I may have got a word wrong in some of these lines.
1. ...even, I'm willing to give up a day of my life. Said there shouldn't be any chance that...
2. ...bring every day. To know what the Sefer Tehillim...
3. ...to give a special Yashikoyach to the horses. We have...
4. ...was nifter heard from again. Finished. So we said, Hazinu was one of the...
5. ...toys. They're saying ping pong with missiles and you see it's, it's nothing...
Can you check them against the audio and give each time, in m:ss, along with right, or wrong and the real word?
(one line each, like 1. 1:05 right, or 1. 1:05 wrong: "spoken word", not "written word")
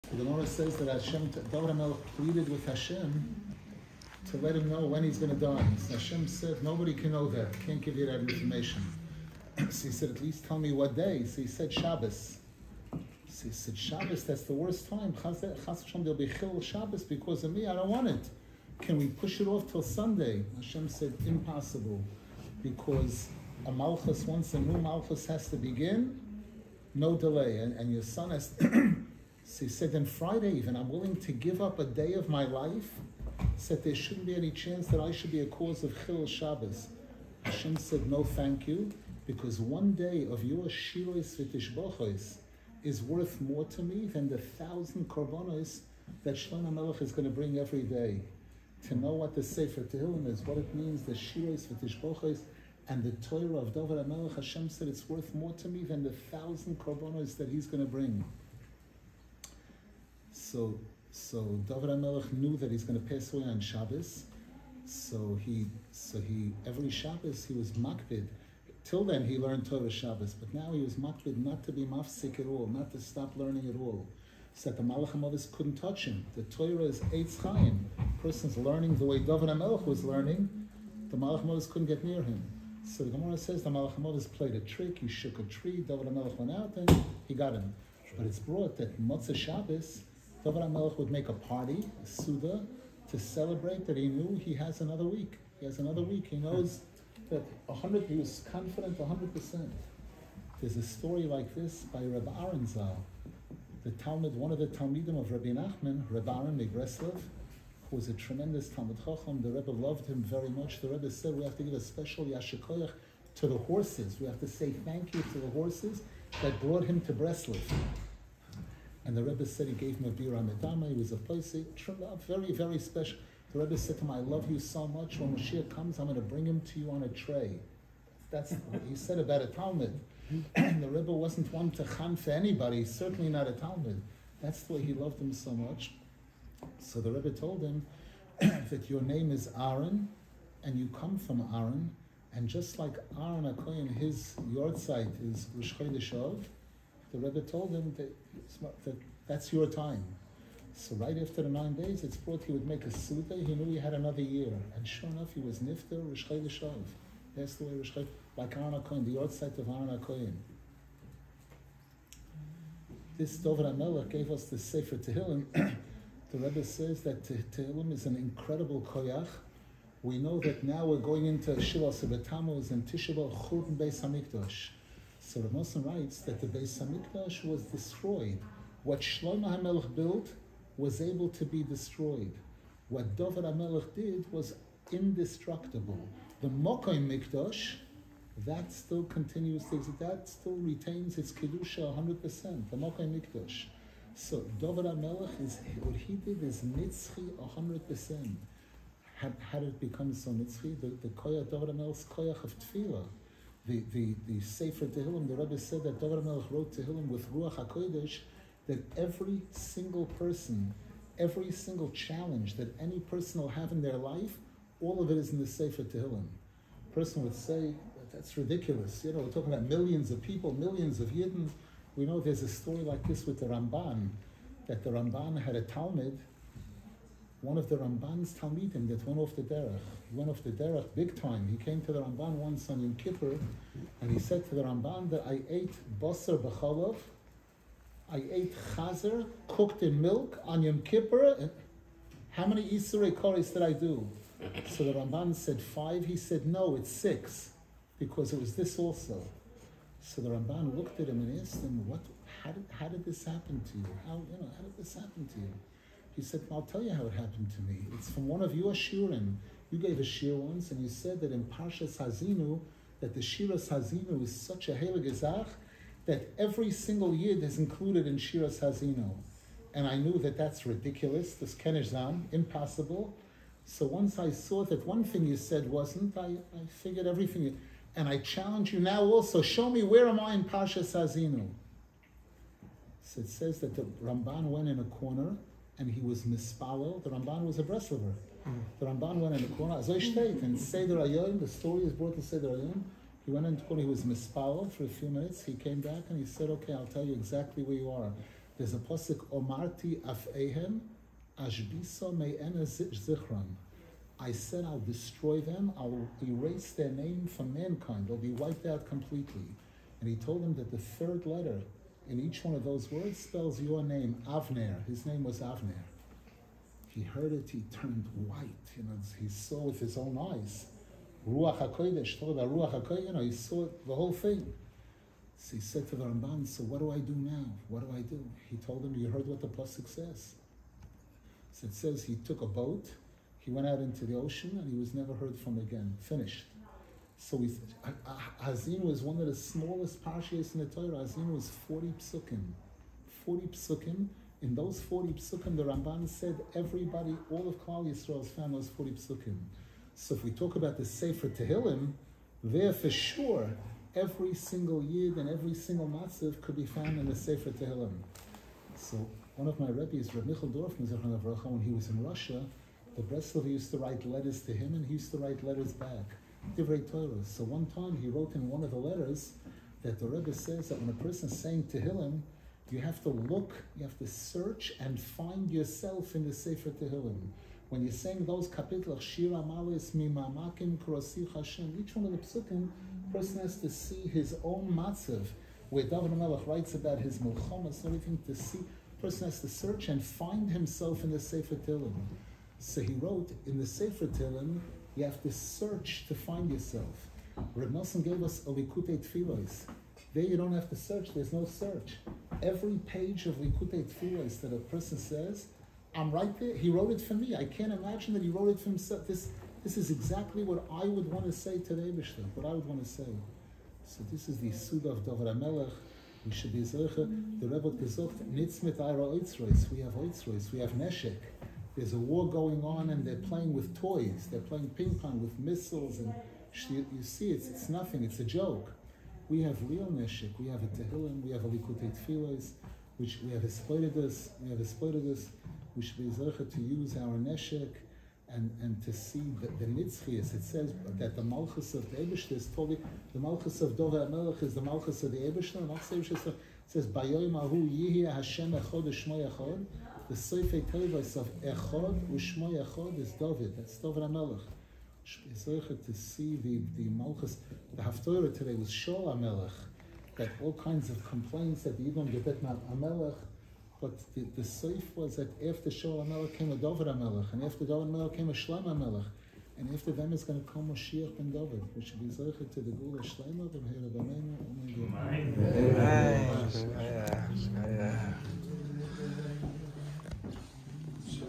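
1. 0:30 right
2. 0:47 right
3. 1:51 right
4. 5:34 wrong: "never", not "nifter"
5. 7:03 wrong: "playing", not "saying".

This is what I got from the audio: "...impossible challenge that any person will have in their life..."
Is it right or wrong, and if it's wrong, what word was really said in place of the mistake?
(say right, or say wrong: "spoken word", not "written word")
wrong: "single", not "impossible".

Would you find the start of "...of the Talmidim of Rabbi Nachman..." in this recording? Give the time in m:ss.
1:44.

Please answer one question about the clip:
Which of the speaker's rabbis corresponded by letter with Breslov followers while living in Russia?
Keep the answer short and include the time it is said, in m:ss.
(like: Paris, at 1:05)
Reb Michel Dorfman, at 6:00.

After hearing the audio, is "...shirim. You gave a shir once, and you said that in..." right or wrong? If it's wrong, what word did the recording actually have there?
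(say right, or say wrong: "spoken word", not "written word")
right.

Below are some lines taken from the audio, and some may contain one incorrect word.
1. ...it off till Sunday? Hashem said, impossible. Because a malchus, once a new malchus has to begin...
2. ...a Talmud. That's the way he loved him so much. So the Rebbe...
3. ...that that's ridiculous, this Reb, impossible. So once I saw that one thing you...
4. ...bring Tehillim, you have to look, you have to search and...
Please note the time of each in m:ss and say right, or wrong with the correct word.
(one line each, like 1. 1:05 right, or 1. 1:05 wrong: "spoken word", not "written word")
1. 0:19 right
2. 2:13 right
3. 4:30 wrong: "Kenizam", not "Reb"
4. 6:11 wrong: "saying", not "bring".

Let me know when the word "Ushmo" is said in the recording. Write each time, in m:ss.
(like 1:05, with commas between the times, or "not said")
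7:32.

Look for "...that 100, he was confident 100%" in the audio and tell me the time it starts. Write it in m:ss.
1:37.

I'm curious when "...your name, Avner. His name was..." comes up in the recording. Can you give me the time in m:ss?
5:13.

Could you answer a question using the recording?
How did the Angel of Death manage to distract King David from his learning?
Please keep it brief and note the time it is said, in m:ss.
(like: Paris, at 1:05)
He shook a tree, at 1:24.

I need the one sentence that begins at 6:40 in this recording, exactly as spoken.
There you don't have to search.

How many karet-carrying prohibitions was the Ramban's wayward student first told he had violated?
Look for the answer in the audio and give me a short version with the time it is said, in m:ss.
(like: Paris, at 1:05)
5, at 4:05.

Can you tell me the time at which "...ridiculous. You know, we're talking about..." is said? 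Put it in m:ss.
3:38.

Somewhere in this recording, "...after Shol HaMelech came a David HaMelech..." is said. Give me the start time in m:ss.
7:45.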